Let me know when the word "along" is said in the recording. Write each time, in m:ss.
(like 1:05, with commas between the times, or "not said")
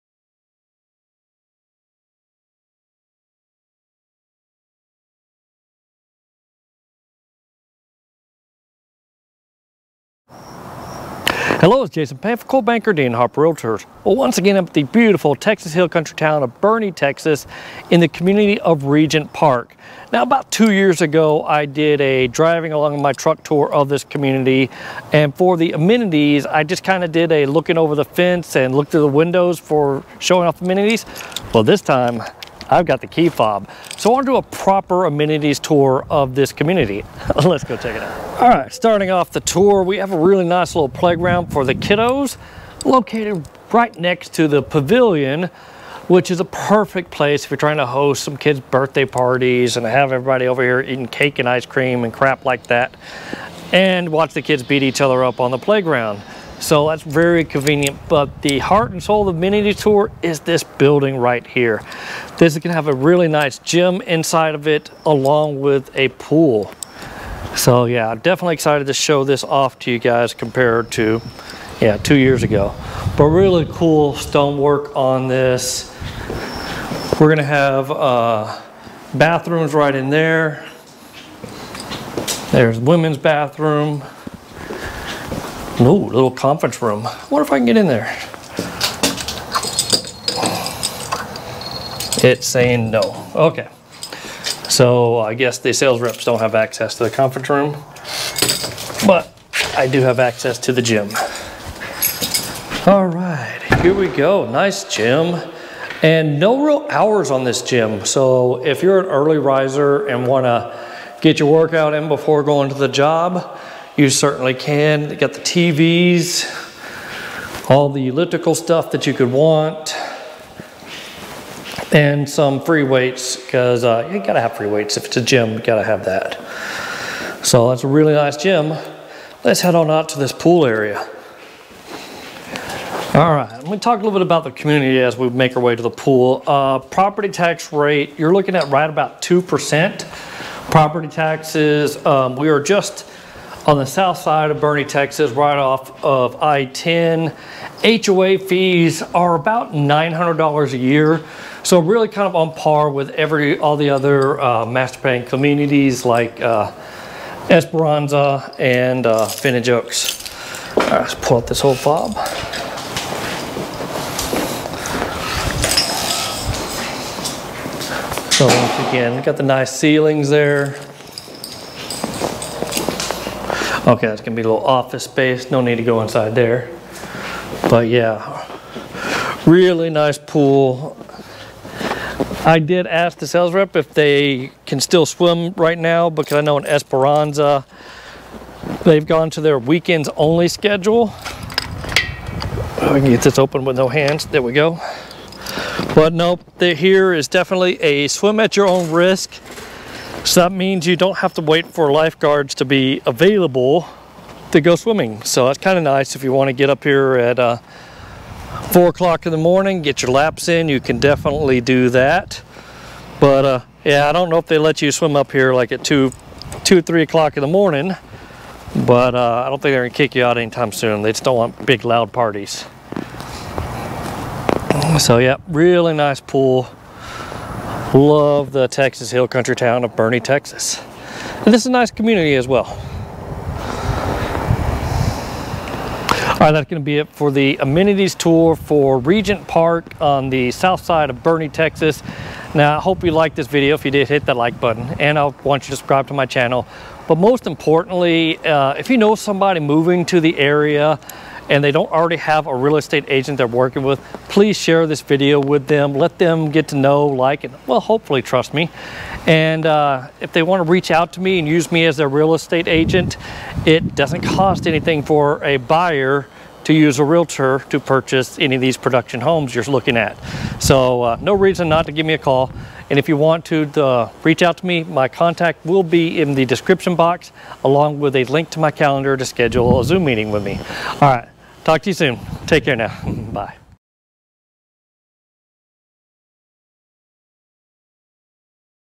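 0:22, 1:05, 4:37.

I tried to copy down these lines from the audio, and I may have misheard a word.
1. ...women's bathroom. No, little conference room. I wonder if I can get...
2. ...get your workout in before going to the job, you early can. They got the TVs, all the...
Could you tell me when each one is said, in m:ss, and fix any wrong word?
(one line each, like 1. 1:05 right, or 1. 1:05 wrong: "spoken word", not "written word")
1. 1:22 right
2. 1:51 wrong: "certainly", not "early".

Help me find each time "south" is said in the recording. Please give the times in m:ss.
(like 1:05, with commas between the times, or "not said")
2:23, 4:00.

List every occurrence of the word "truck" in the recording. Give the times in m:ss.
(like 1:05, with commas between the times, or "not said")
0:23.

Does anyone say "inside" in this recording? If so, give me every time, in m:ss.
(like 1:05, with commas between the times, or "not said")
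1:04, 2:56.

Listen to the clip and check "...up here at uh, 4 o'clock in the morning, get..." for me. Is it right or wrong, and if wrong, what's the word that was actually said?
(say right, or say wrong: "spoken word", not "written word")
right.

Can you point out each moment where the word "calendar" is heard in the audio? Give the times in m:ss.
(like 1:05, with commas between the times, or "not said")
4:38.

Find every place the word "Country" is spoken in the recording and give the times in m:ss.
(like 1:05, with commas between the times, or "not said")
0:15, 3:49.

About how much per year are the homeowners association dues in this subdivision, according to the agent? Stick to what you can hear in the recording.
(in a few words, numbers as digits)
$900.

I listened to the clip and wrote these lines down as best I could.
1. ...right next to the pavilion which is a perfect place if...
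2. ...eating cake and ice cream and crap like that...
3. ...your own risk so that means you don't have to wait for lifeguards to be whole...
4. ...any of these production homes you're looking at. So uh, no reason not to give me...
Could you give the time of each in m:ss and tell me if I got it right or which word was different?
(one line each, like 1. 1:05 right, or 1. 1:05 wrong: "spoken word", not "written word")
1. 0:43 right
2. 0:50 right
3. 3:18 wrong: "available", not "whole"
4. 4:28 right.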